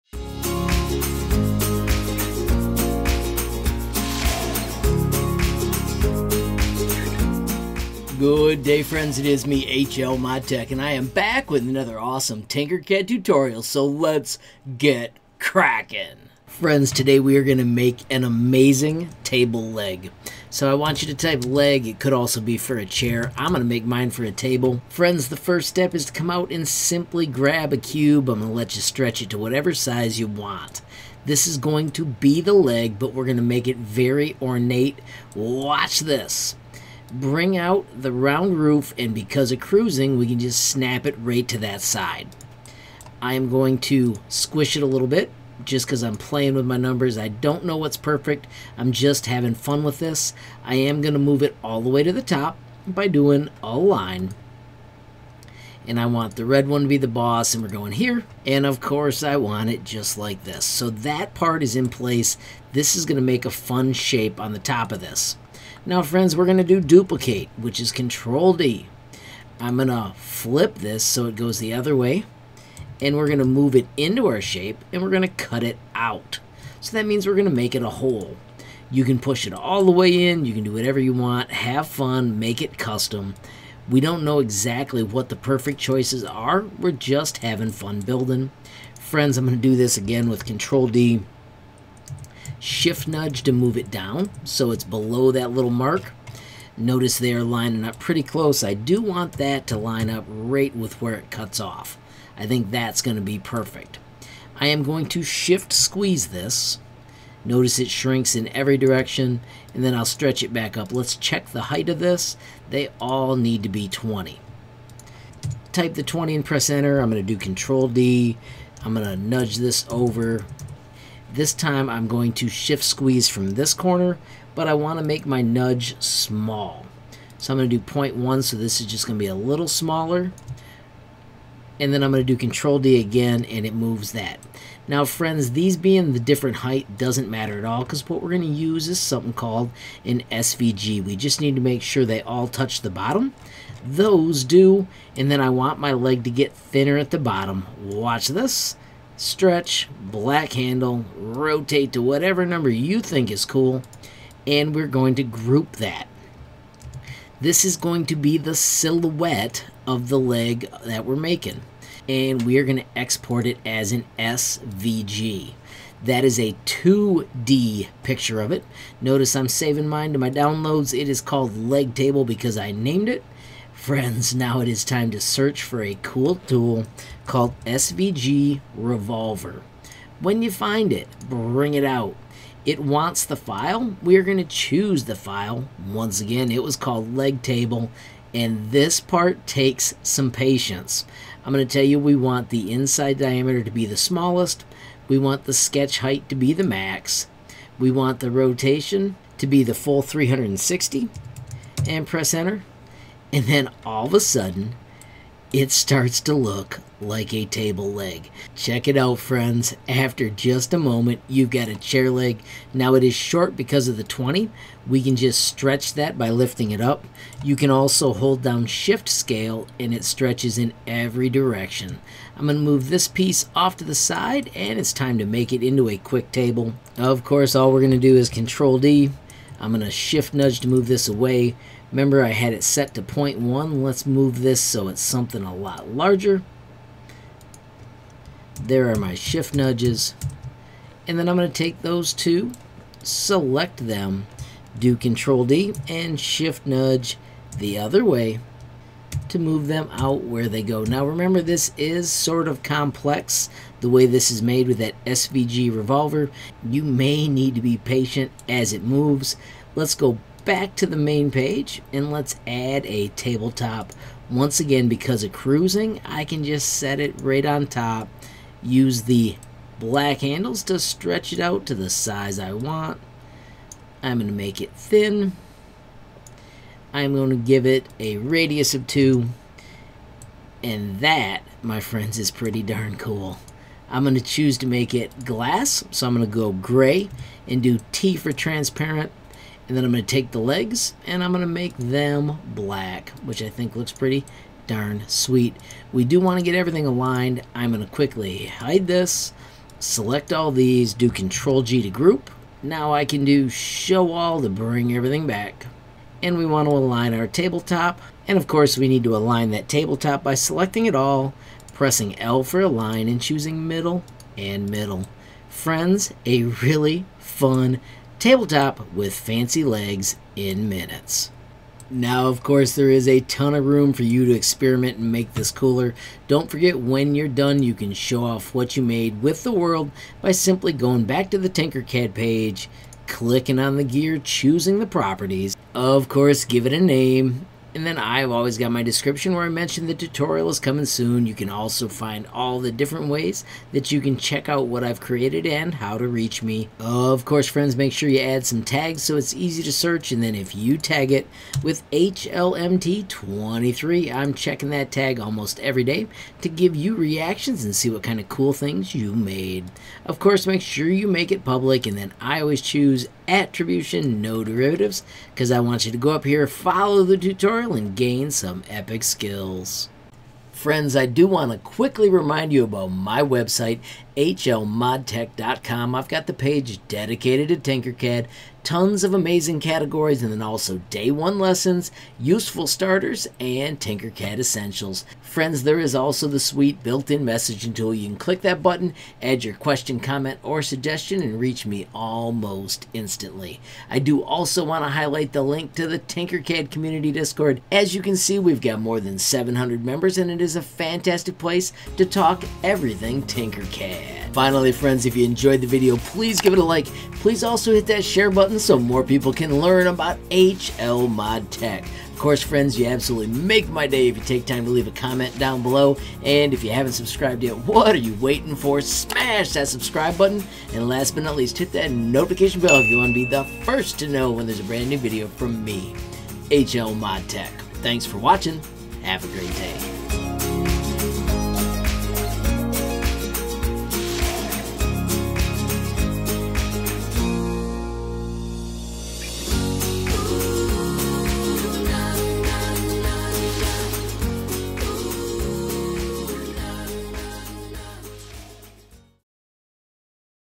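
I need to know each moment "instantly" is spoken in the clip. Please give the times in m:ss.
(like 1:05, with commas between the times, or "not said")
6:32.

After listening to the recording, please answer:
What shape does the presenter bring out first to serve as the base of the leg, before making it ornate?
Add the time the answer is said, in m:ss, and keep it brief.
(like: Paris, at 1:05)
Cube, at 0:27.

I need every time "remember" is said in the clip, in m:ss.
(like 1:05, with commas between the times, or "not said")
3:51, 4:11.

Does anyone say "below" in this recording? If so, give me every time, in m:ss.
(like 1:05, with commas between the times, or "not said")
1:34, 6:55.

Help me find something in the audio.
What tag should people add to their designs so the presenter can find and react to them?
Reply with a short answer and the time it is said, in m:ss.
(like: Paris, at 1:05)
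HLMT23, at 5:51.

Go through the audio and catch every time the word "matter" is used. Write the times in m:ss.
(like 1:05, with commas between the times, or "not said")
2:17.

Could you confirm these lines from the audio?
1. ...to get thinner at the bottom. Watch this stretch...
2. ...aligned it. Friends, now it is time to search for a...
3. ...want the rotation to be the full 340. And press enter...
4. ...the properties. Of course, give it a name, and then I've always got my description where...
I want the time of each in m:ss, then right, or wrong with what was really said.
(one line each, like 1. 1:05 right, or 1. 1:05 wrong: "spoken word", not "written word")
1. 2:26 right
2. 2:52 wrong: "named", not "aligned"
3. 3:17 wrong: "360", not "340"
4. 5:34 right.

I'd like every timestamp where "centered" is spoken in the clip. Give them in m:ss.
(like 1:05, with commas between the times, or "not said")
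not said.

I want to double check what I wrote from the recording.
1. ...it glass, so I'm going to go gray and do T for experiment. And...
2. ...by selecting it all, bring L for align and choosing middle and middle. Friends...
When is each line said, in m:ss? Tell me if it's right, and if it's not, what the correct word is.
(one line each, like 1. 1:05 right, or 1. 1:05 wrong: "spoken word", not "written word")
1. 4:44 wrong: "transparent", not "experiment"
2. 5:10 wrong: "pressing", not "bring".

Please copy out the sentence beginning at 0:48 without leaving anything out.
I'm just having fun with this.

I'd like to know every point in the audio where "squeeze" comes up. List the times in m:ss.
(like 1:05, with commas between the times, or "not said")
1:45, 2:02.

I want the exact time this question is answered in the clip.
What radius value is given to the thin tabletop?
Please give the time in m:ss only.
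4:38.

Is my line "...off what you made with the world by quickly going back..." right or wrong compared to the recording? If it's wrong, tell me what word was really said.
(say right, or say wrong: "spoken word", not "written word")
wrong: "simply", not "quickly".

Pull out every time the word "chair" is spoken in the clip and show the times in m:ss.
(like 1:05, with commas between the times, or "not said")
0:22, 3:31.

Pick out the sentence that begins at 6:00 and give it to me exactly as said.
Of course, make sure you make it public.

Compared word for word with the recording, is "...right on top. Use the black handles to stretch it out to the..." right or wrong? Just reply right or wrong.
right.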